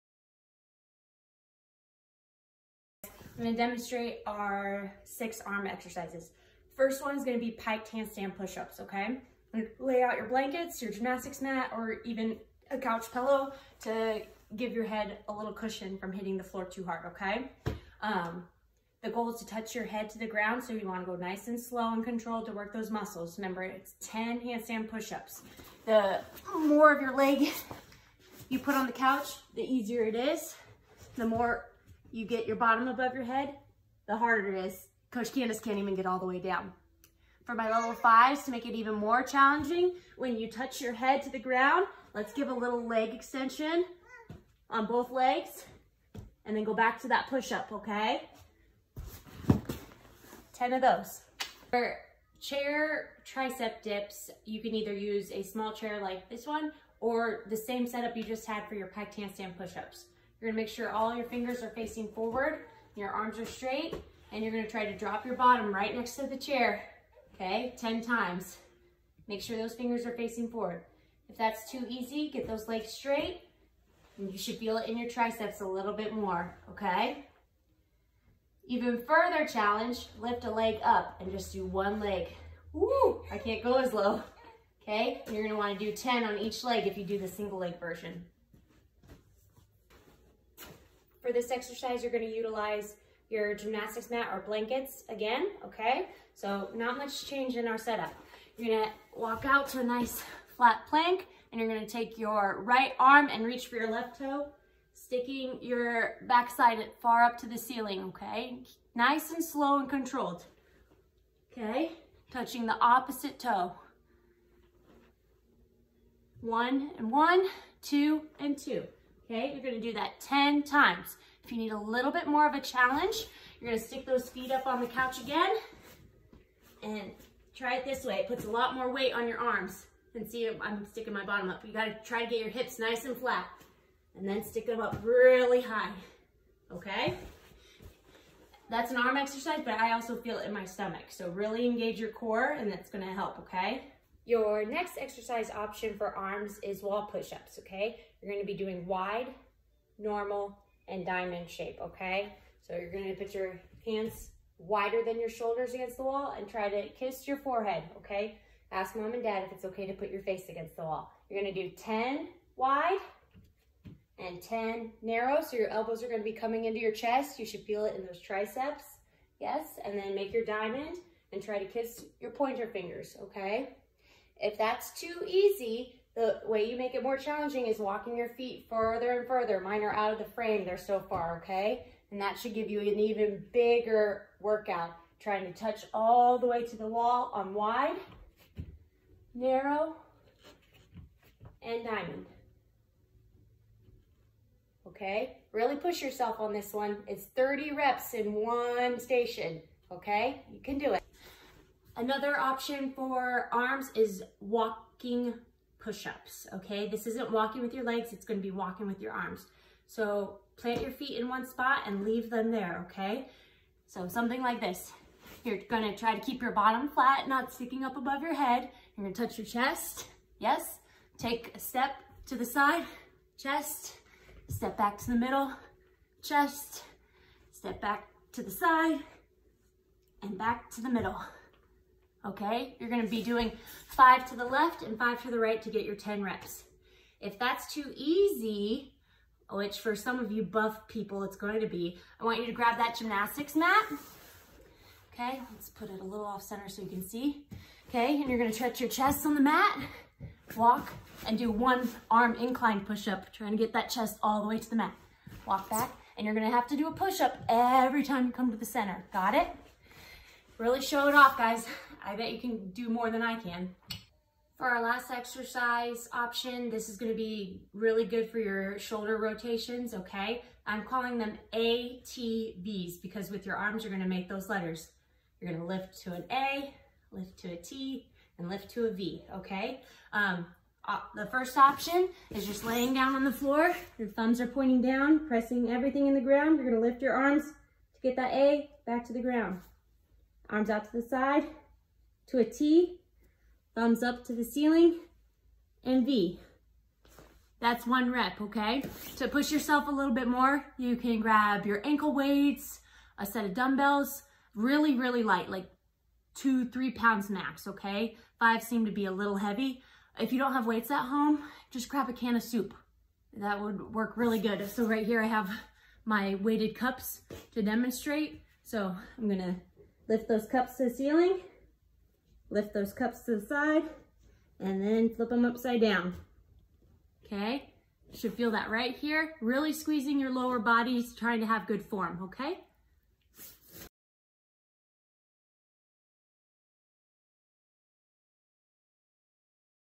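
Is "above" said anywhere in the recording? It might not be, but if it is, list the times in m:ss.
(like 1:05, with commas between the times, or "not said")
0:32, 3:37.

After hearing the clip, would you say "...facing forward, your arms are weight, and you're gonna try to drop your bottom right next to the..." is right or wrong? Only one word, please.
wrong.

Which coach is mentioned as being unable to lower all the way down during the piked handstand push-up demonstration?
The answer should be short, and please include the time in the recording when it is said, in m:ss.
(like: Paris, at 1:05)
Coach Candace, at 0:35.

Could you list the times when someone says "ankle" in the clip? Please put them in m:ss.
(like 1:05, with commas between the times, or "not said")
5:01.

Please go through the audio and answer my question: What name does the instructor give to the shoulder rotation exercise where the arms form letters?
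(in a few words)
ATVs.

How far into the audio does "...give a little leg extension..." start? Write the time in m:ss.
0:42.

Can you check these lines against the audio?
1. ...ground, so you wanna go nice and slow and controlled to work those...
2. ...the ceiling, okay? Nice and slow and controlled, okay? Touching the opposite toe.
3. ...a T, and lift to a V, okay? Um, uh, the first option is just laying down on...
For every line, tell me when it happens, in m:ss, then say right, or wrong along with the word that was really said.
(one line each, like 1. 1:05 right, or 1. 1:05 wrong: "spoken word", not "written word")
1. 0:20 right
2. 1:47 right
3. 4:37 right.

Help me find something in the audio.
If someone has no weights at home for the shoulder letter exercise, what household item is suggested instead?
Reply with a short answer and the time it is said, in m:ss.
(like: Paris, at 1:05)
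a can of soup, at 5:12.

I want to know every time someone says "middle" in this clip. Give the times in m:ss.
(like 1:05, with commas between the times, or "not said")
3:45, 3:50.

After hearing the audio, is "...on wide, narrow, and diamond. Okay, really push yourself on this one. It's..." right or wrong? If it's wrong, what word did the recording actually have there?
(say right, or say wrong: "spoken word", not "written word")
right.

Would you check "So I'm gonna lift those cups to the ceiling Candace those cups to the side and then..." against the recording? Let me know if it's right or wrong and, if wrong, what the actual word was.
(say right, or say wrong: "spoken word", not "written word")
wrong: "Lift", not "Candace".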